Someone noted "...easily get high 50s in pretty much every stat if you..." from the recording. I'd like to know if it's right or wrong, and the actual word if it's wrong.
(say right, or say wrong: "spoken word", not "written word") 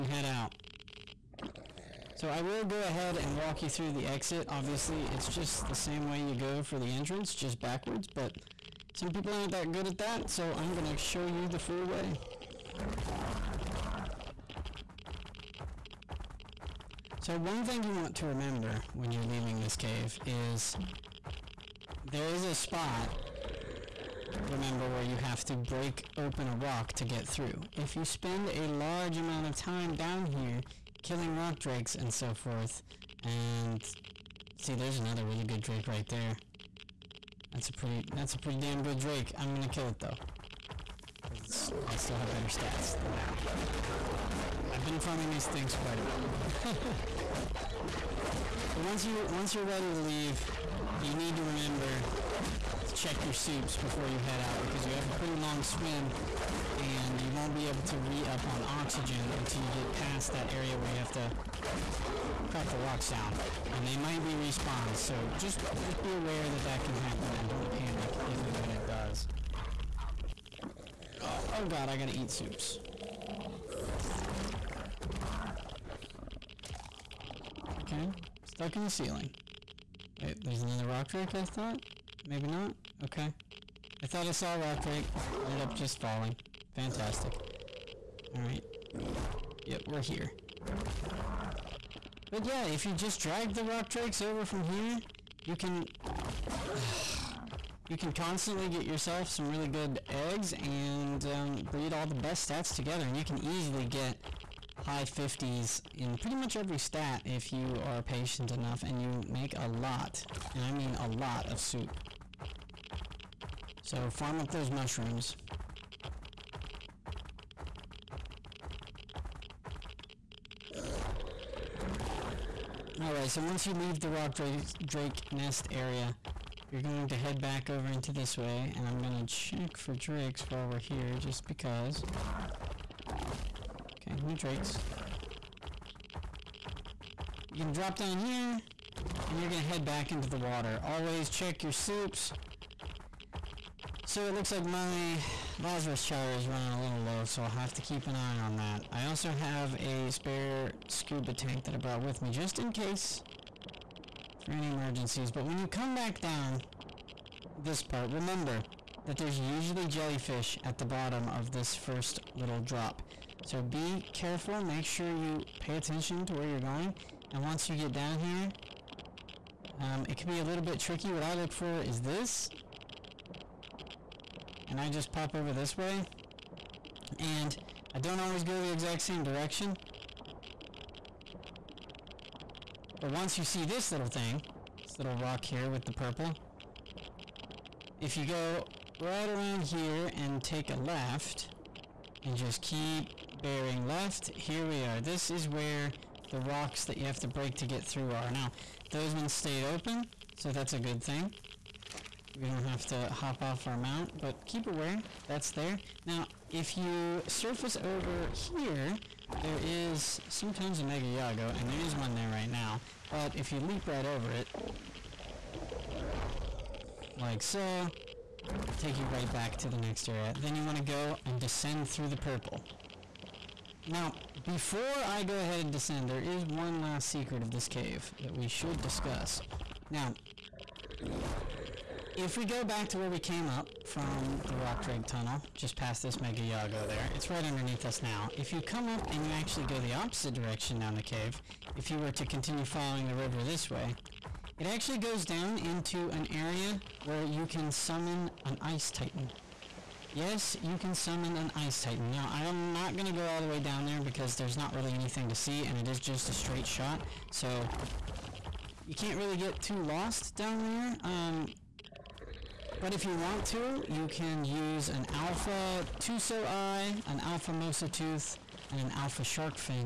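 right.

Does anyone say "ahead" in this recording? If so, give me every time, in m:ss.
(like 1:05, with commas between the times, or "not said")
0:02, 3:45.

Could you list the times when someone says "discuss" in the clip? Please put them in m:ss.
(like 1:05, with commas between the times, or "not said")
3:48.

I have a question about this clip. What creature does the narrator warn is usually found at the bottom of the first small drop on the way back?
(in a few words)
Jellyfish.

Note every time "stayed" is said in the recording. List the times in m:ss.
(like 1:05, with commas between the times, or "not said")
3:19.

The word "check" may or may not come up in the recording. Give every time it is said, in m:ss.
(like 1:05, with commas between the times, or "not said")
0:52, 2:09, 2:21.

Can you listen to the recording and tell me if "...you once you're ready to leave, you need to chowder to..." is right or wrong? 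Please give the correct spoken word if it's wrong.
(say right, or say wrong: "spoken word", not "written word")
wrong: "remember", not "chowder".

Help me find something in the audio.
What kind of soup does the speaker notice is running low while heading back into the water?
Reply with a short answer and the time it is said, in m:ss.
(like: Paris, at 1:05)
Lazarus chowder, at 2:25.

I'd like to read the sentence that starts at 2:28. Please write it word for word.
I also have a spare scuba tank that I brought with me just in case for any emergencies.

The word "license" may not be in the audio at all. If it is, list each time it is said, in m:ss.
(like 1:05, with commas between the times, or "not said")
not said.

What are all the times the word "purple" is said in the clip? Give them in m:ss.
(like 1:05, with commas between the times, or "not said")
3:05, 3:42.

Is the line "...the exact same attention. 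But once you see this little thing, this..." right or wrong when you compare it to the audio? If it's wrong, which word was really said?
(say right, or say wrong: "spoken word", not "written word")
wrong: "direction", not "attention".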